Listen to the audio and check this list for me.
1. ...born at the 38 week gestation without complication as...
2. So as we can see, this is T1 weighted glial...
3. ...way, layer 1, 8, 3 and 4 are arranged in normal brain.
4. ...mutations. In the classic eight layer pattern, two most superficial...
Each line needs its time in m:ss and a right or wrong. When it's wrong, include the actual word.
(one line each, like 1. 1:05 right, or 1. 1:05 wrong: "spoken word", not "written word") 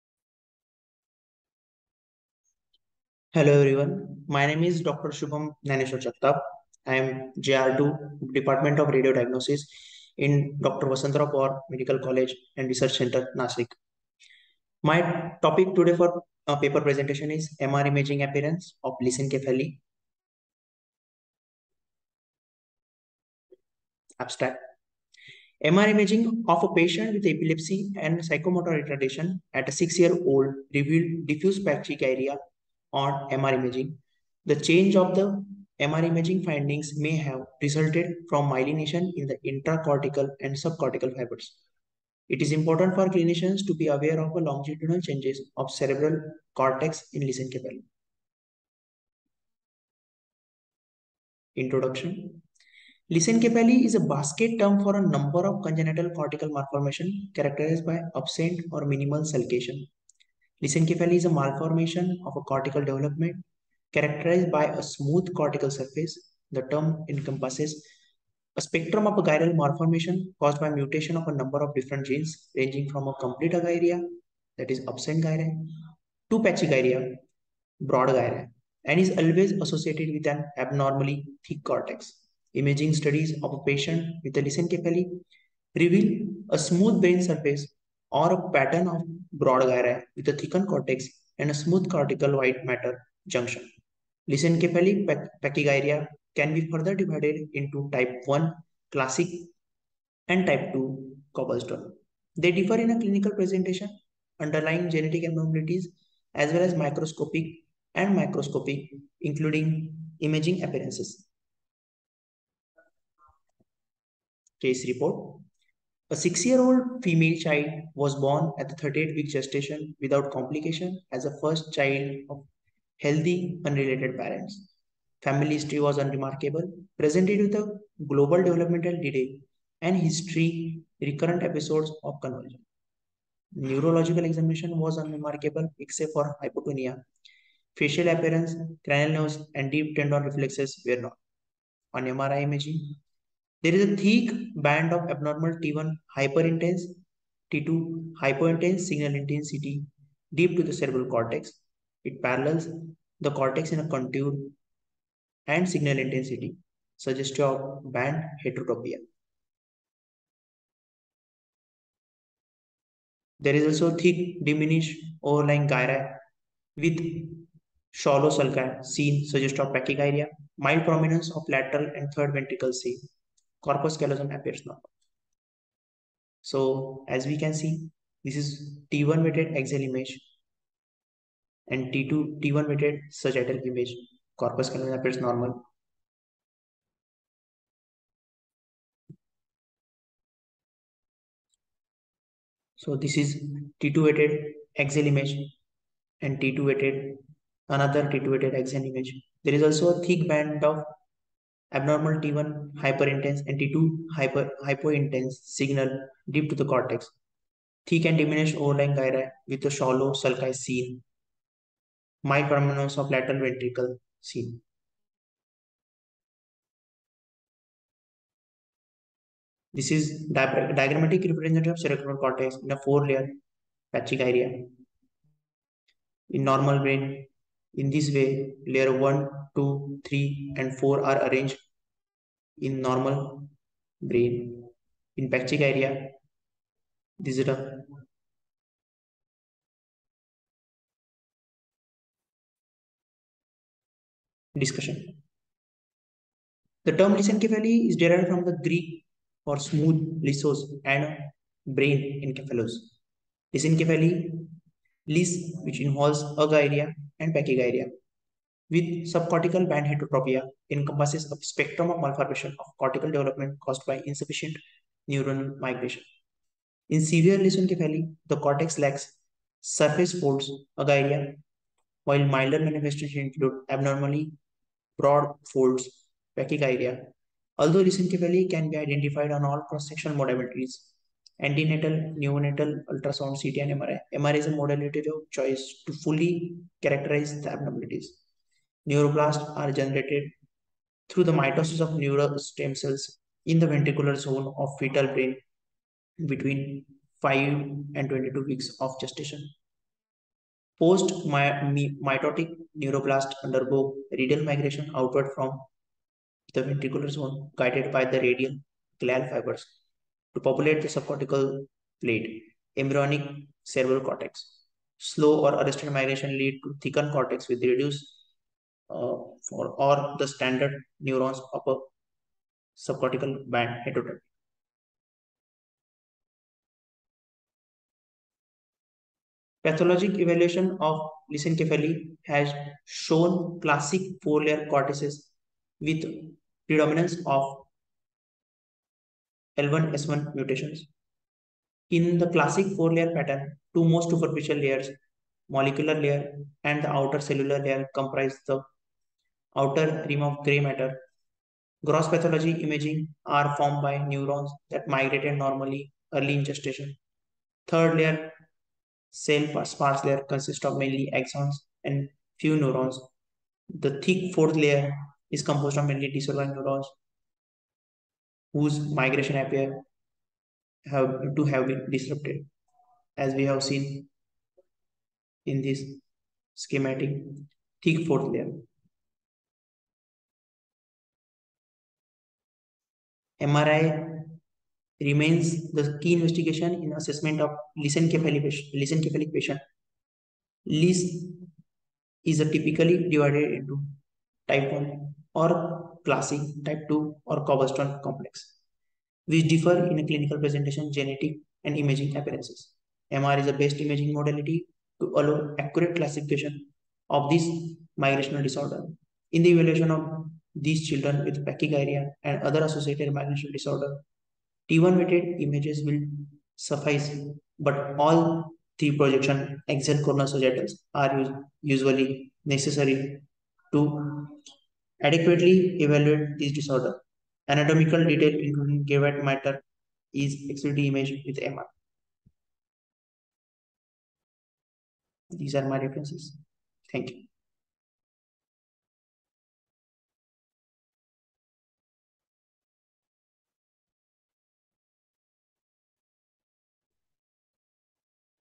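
1. 1:58 right
2. 2:56 wrong: "axial", not "glial"
3. 3:48 wrong: "2", not "8"
4. 5:40 wrong: "four", not "eight".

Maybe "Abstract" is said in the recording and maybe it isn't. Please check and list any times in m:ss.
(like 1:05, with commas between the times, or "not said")
0:24.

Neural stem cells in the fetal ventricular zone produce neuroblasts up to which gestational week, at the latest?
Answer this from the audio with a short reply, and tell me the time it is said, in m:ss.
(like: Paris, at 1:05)
22, at 4:58.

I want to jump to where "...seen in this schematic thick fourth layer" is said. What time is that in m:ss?
6:13.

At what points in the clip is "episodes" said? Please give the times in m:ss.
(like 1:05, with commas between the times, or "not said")
2:11.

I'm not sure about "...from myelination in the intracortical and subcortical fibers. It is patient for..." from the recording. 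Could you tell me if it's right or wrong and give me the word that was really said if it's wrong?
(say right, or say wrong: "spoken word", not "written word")
wrong: "important", not "patient".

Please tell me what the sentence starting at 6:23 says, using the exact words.
MRI remains the key investigation in assessment of lissencephalic patient.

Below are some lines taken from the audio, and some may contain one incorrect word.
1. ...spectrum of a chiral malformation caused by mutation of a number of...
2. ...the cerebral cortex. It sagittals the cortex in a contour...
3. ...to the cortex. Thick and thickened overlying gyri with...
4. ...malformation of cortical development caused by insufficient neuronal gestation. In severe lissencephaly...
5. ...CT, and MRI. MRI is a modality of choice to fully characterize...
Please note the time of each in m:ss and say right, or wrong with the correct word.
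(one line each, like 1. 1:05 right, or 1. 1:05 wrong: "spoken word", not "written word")
1. 1:08 right
2. 2:30 wrong: "parallels", not "sagittals"
3. 3:26 wrong: "diminished", not "thickened"
4. 4:22 wrong: "migration", not "gestation"
5. 4:43 right.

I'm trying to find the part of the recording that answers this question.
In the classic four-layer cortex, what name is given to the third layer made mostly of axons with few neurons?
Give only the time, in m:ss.
5:59.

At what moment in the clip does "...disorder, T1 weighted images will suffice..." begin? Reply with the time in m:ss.
6:53.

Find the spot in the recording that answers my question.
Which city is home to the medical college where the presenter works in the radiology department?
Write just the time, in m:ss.
0:13.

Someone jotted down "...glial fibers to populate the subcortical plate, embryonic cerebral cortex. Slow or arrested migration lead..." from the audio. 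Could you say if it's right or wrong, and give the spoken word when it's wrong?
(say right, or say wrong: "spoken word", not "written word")
right.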